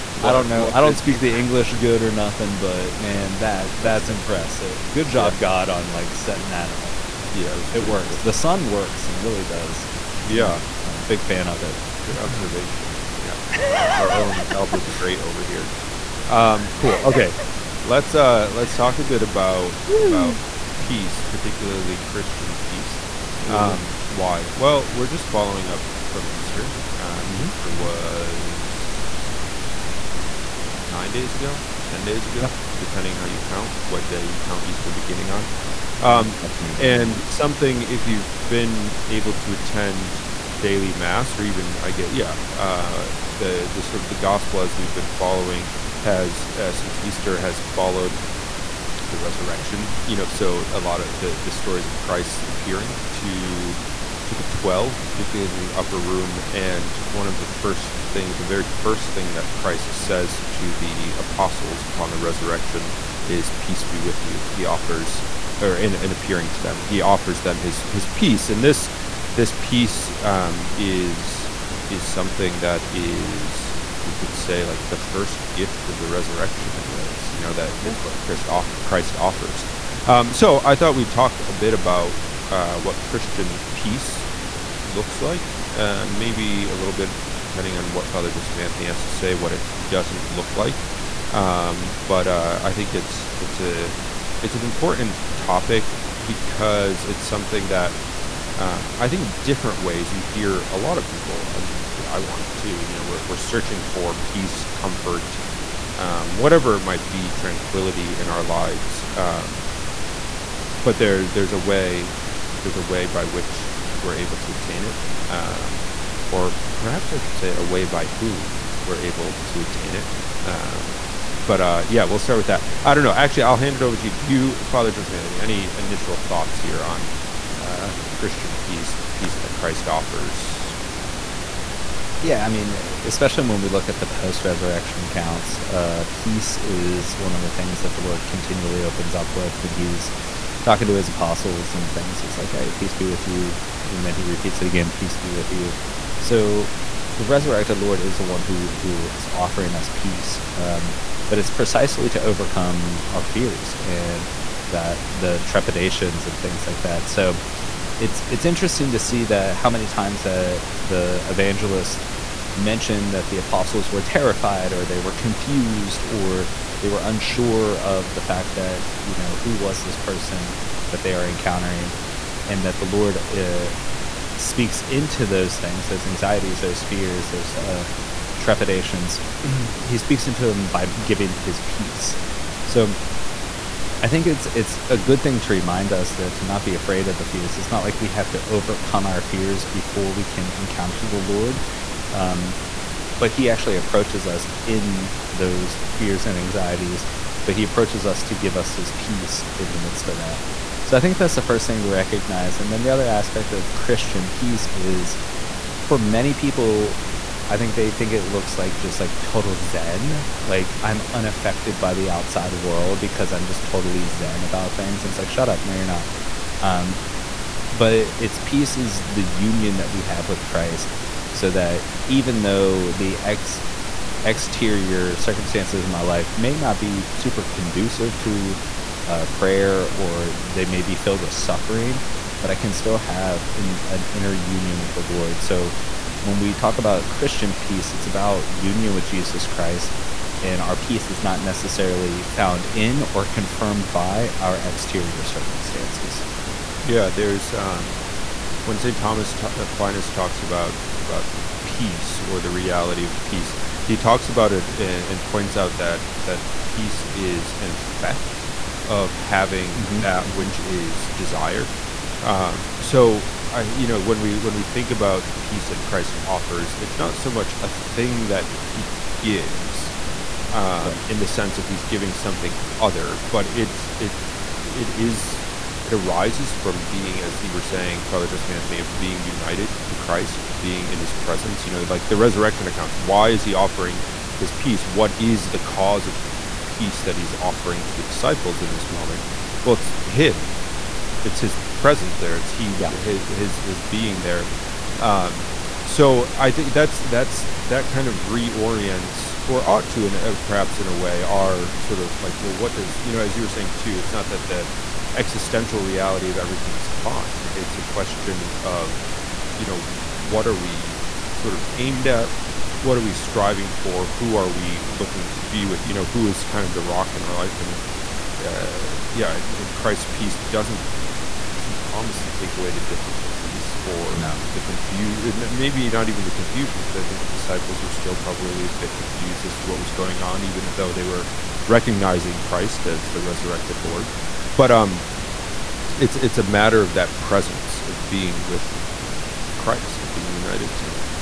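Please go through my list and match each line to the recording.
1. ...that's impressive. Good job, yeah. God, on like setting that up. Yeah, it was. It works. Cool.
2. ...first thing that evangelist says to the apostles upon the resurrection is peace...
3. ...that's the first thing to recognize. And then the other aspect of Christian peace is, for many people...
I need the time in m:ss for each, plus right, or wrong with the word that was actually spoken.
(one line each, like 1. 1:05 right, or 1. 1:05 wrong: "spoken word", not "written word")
1. 0:03 right
2. 0:58 wrong: "christ", not "evangelist"
3. 3:21 right.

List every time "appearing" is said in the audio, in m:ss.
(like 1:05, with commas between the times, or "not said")
0:52, 1:06.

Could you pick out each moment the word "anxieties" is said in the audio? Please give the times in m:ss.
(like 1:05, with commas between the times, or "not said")
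2:56, 3:16.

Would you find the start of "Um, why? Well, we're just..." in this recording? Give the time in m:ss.
0:23.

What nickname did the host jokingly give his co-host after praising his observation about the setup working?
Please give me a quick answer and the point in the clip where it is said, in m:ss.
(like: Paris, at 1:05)
Albert the Great, at 0:14.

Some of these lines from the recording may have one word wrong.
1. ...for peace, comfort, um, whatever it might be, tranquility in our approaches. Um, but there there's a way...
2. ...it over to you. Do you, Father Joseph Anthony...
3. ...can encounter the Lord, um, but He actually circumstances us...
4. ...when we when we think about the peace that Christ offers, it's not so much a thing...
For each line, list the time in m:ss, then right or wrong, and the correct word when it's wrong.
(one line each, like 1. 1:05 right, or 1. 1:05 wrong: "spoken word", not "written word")
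1. 1:43 wrong: "lives", not "approaches"
2. 2:03 right
3. 3:10 wrong: "approaches", not "circumstances"
4. 4:24 right.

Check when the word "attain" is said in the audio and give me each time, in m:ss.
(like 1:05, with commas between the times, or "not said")
1:54, 1:59.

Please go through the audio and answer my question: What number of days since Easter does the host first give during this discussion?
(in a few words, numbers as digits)
9.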